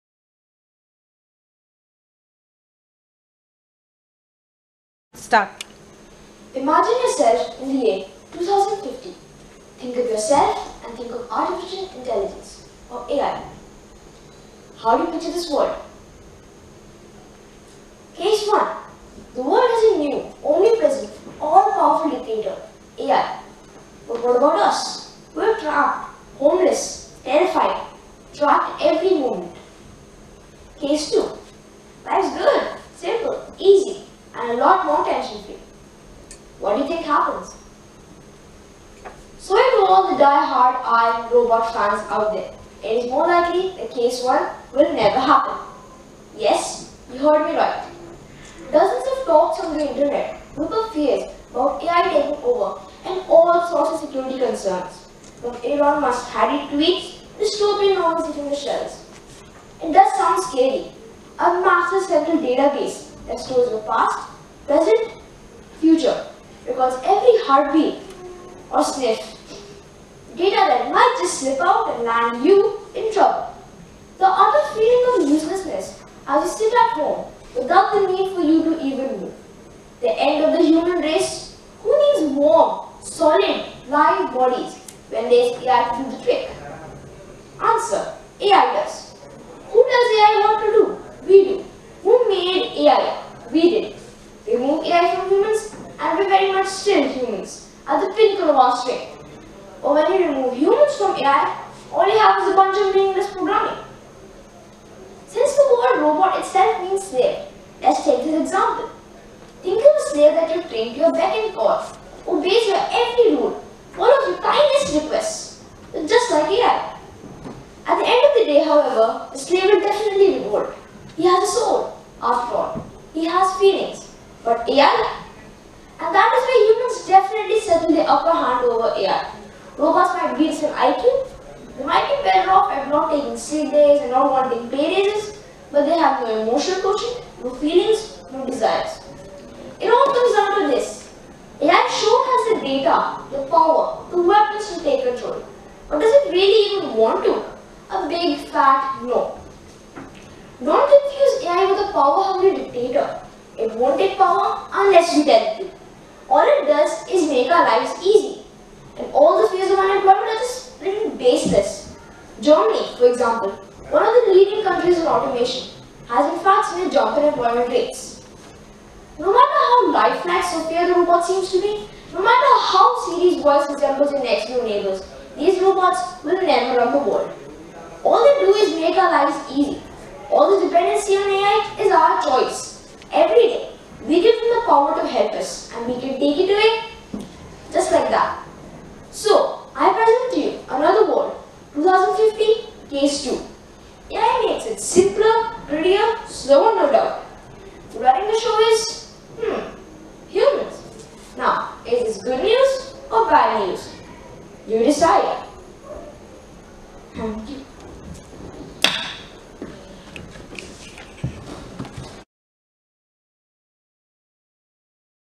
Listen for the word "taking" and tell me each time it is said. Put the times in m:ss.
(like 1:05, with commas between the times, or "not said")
0:52, 2:13.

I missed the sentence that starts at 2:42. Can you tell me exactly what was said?
Germany, for example, one of the leading countries in automation, has in fact seen a jump in employment rates.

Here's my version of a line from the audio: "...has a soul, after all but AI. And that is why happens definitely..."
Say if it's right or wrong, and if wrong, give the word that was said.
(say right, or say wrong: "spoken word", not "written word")
wrong: "humans", not "happens".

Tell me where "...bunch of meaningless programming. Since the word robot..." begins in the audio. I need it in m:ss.
1:42.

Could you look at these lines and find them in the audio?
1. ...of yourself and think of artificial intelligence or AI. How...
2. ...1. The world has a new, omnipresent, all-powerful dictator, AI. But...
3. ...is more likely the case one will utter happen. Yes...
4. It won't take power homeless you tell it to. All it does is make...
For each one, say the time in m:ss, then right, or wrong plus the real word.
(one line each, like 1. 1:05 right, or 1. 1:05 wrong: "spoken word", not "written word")
1. 0:09 right
2. 0:18 right
3. 0:43 wrong: "never", not "utter"
4. 2:33 wrong: "unless", not "homeless".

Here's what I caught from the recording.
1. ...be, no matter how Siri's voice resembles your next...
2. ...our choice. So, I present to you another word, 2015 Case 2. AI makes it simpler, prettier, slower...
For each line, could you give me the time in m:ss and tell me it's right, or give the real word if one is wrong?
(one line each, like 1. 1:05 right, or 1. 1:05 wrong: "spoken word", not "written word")
1. 2:51 right
2. 3:01 right.